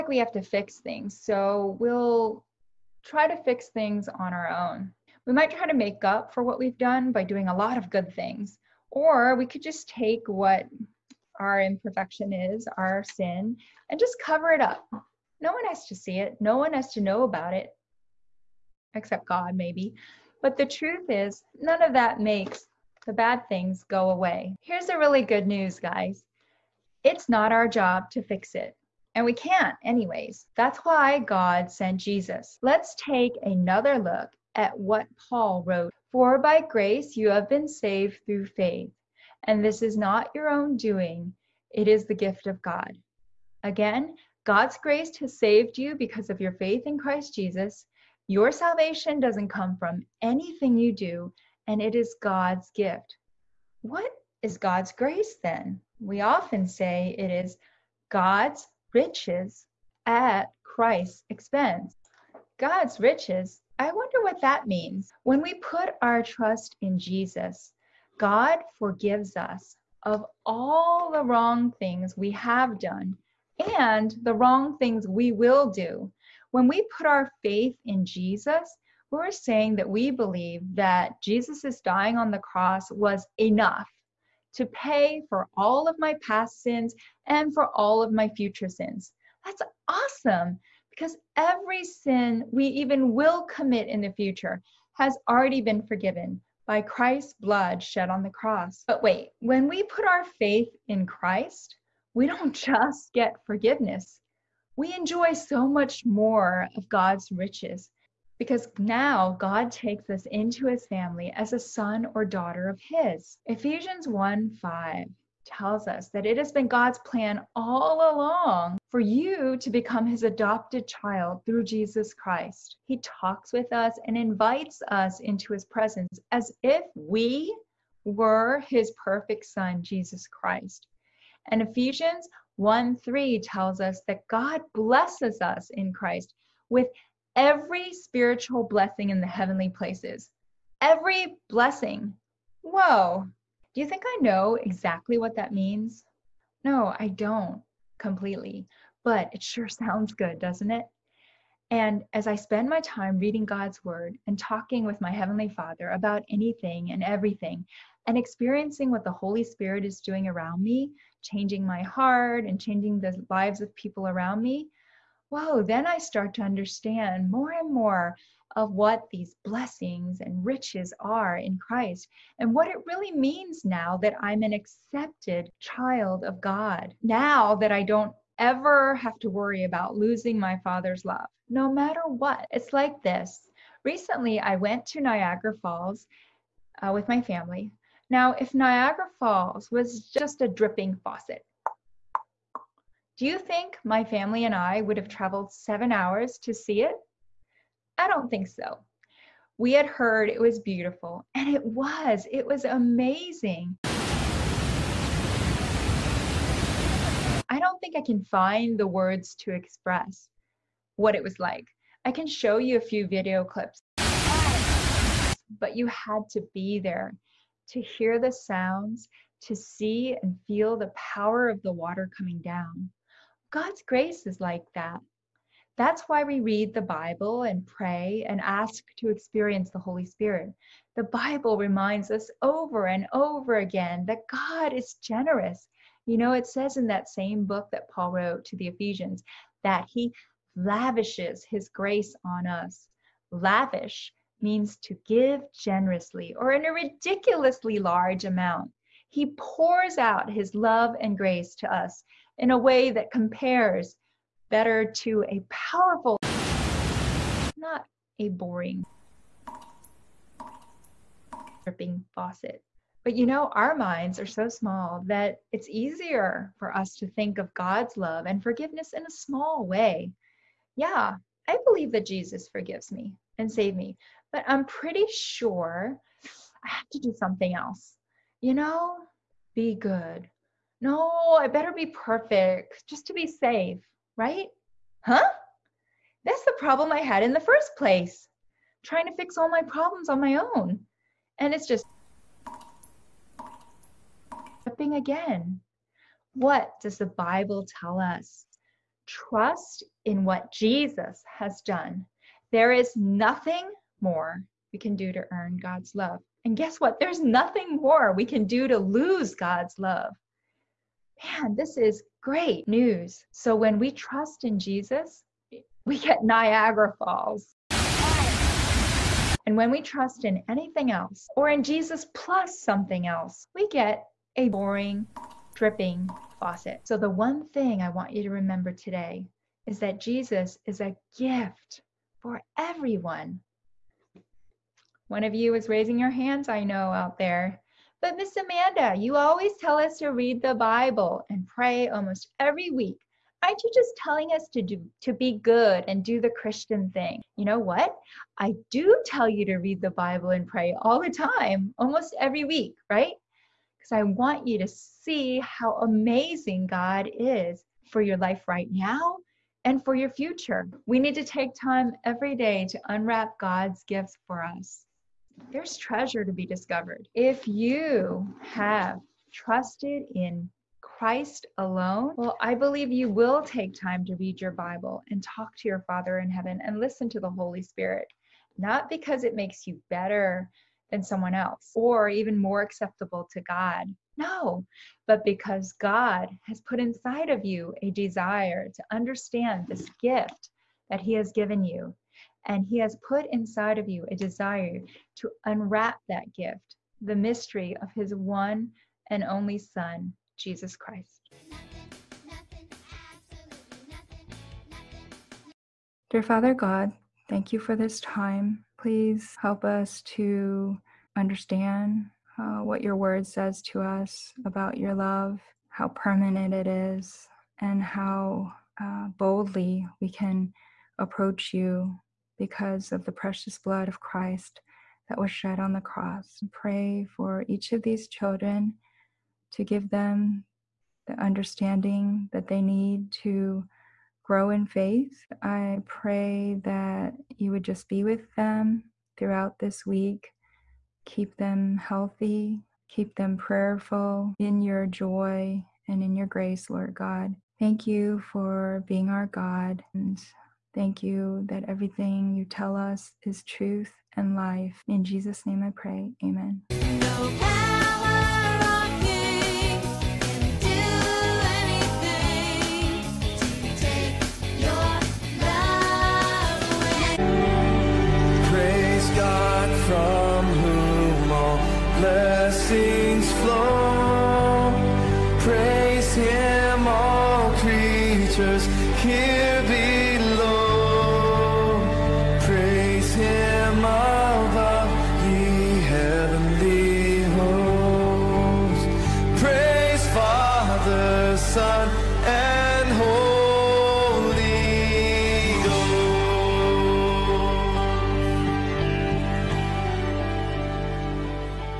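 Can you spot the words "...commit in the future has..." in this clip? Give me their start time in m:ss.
1:33.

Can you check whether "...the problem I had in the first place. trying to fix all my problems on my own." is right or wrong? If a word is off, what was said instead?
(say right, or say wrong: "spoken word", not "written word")
right.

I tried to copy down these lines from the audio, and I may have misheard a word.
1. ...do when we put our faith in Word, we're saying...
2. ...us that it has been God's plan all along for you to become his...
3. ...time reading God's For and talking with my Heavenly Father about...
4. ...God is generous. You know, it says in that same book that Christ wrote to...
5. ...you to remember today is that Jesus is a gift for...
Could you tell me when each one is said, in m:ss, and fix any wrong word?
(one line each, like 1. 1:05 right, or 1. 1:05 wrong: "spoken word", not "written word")
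1. 1:15 wrong: "Jesus", not "Word"
2. 1:55 right
3. 2:32 wrong: "Word", not "For"
4. 3:54 wrong: "Paul", not "Christ"
5. 5:28 right.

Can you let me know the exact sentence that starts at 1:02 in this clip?
God's riches, I wonder what that means.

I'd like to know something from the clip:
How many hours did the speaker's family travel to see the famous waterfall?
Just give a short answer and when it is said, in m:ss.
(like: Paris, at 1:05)
7, at 3:15.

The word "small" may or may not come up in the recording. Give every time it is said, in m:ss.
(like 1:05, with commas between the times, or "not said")
4:24, 4:29.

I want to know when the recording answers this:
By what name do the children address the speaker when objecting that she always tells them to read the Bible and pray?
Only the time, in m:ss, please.
5:38.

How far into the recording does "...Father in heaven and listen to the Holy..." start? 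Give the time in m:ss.
6:15.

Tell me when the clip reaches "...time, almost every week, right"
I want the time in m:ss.
5:51.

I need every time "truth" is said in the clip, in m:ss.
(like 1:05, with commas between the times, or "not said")
0:20, 7:33.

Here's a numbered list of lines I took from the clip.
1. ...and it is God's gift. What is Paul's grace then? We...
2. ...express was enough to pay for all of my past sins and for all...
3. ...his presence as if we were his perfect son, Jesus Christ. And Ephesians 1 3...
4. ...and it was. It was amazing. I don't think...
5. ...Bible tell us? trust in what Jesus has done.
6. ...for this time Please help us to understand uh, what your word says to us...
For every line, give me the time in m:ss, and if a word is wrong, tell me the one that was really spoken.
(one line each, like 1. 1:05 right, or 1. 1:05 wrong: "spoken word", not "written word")
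1. 0:51 wrong: "God", not "Paul"
2. 1:22 wrong: "cross", not "express"
3. 2:05 right
4. 3:21 right
5. 4:57 right
6. 6:47 right.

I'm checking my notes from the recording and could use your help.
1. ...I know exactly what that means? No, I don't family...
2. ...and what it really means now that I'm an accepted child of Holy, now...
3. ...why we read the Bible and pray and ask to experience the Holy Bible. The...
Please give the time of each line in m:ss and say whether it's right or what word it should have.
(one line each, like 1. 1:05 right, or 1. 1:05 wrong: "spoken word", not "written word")
1. 2:24 wrong: "completely", not "family"
2. 2:52 wrong: "God", not "Holy"
3. 3:46 wrong: "Spirit", not "Bible".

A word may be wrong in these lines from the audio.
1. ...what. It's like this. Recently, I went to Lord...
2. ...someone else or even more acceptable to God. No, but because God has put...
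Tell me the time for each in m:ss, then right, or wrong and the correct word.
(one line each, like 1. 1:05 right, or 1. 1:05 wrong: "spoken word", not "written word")
1. 3:02 wrong: "Niagara", not "Lord"
2. 6:21 right.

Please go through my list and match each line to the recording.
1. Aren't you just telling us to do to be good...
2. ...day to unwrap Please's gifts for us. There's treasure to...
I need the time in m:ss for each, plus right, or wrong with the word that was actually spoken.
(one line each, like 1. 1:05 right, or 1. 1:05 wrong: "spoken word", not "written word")
1. 5:43 right
2. 6:02 wrong: "God", not "Please".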